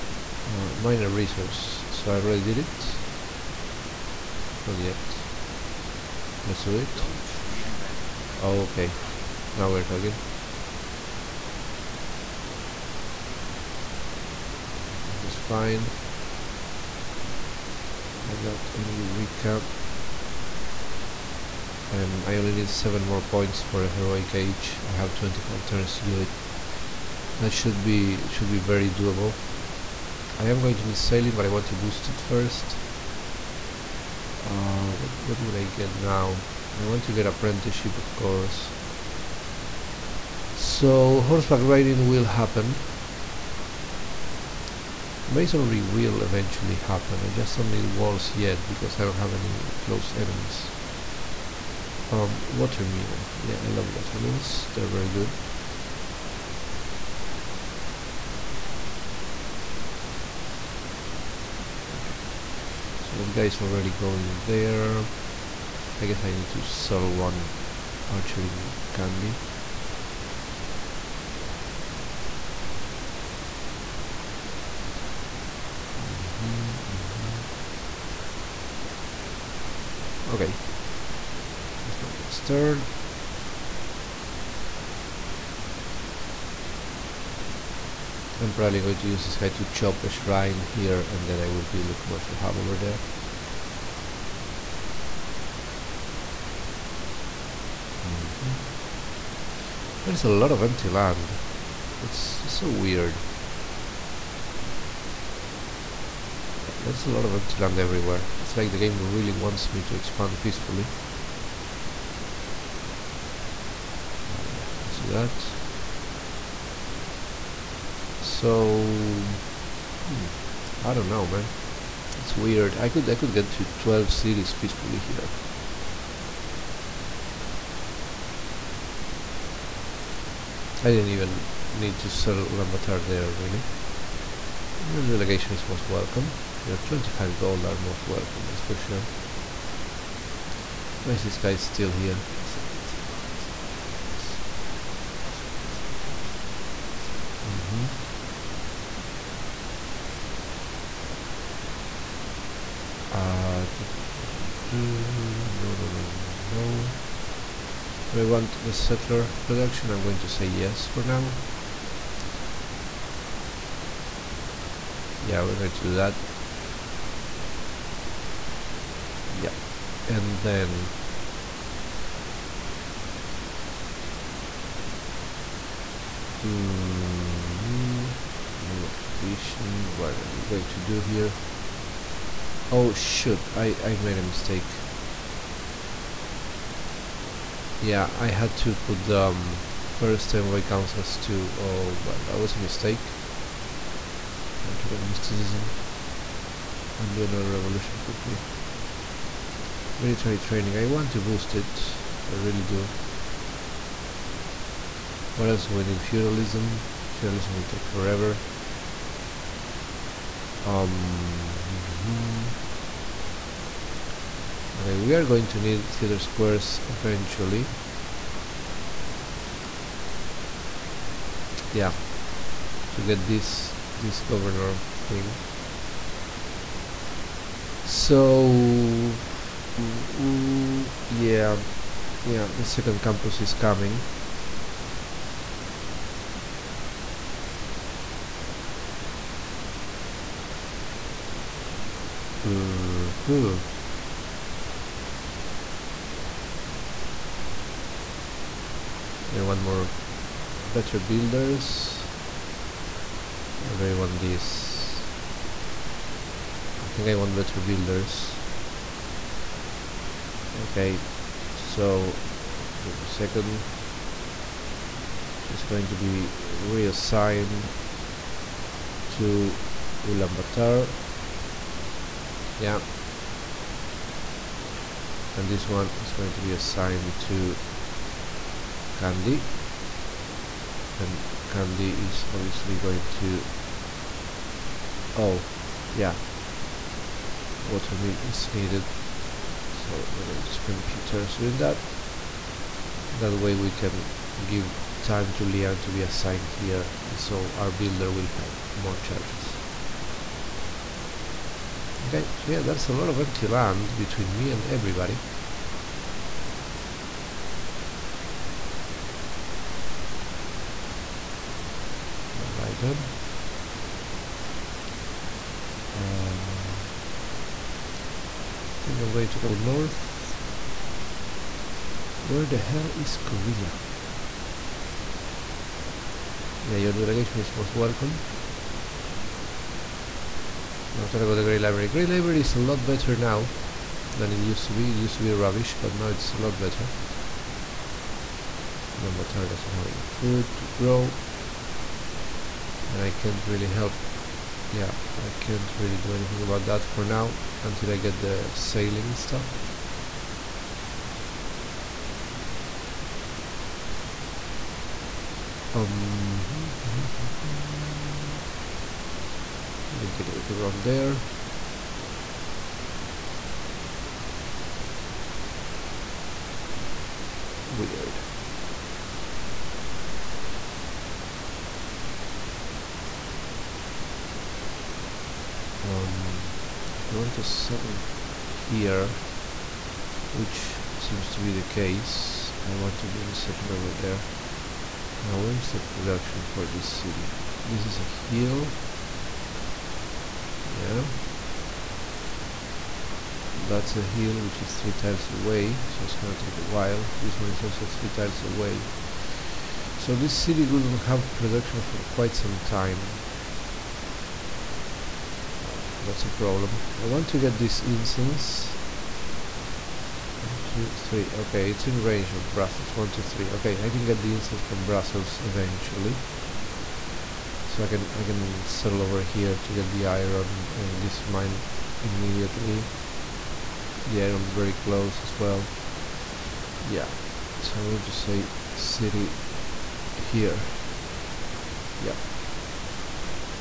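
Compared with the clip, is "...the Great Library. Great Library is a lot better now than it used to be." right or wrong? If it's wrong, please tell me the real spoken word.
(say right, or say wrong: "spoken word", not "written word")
right.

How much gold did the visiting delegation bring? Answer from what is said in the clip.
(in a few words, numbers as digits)
25 gold.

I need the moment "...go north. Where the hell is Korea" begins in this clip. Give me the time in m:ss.
5:19.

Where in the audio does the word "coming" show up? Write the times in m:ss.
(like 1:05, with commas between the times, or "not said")
3:53.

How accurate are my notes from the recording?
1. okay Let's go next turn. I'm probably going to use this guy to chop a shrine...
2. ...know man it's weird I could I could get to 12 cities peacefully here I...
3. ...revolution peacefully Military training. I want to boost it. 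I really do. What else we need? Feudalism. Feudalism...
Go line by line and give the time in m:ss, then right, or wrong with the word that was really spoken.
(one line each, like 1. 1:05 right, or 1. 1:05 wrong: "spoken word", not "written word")
1. 1:20 right
2. 2:01 right
3. 3:17 wrong: "quickly", not "peacefully".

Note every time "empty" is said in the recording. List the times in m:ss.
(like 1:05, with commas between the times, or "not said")
1:40, 1:47, 5:03.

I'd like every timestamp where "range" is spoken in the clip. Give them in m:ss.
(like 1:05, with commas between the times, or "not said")
6:52.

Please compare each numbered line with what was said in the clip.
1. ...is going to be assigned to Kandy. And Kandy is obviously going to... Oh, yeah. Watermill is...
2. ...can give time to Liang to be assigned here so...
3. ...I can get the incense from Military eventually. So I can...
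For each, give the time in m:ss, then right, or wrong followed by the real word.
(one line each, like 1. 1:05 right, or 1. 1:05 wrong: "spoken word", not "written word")
1. 4:35 right
2. 4:53 right
3. 6:53 wrong: "Brussels", not "Military".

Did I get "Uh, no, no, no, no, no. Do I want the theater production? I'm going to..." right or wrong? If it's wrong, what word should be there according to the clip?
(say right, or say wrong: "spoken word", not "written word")
wrong: "settler", not "theater".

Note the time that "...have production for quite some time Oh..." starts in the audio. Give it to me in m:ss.
6:41.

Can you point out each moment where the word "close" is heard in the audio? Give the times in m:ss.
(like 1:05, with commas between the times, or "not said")
0:49, 7:04.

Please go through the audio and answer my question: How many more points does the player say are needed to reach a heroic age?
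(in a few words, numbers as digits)
7.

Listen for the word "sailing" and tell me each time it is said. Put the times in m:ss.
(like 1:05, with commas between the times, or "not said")
0:30, 5:48.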